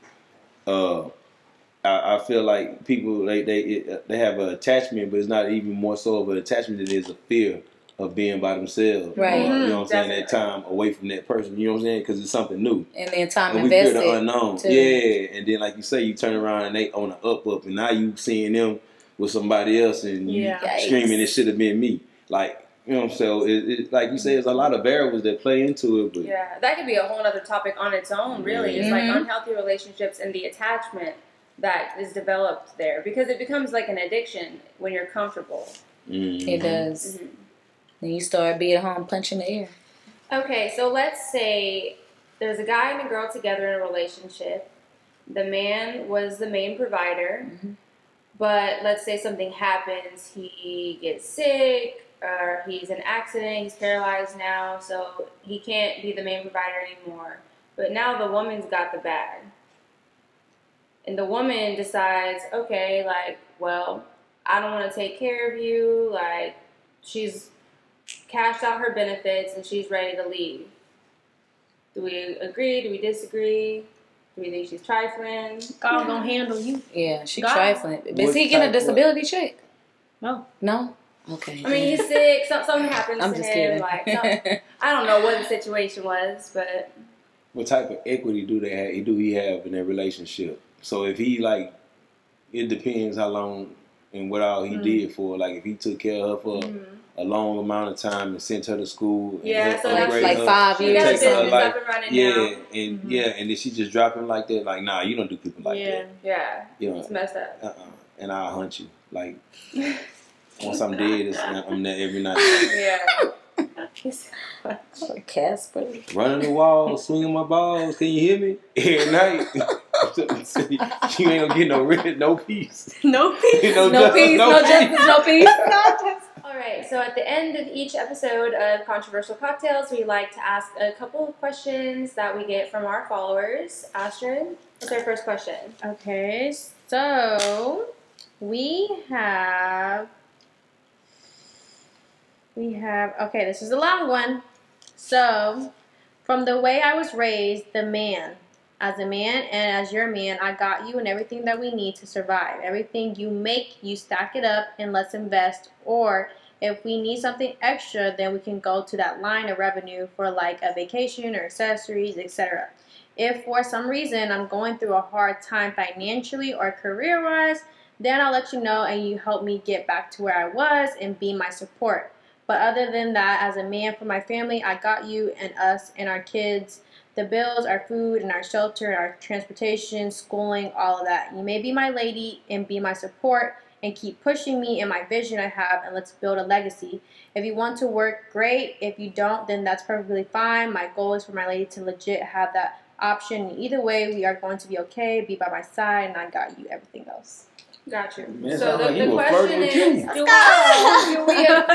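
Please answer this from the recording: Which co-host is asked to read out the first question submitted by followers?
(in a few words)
Astrid.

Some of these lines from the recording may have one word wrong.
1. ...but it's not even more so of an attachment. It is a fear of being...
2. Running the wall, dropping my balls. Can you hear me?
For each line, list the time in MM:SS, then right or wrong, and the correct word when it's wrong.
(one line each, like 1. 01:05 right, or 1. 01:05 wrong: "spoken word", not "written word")
1. 00:05 right
2. 01:56 wrong: "swinging", not "dropping".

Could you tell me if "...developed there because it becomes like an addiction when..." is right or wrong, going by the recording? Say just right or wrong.
right.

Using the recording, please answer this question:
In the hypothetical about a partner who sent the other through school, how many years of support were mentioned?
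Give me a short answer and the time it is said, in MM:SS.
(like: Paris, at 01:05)
5, at 01:40.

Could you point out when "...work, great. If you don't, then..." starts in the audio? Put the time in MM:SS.
03:07.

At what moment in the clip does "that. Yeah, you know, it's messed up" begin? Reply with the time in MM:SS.
01:46.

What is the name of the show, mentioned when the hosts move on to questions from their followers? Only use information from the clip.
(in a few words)
Controversial Cocktails.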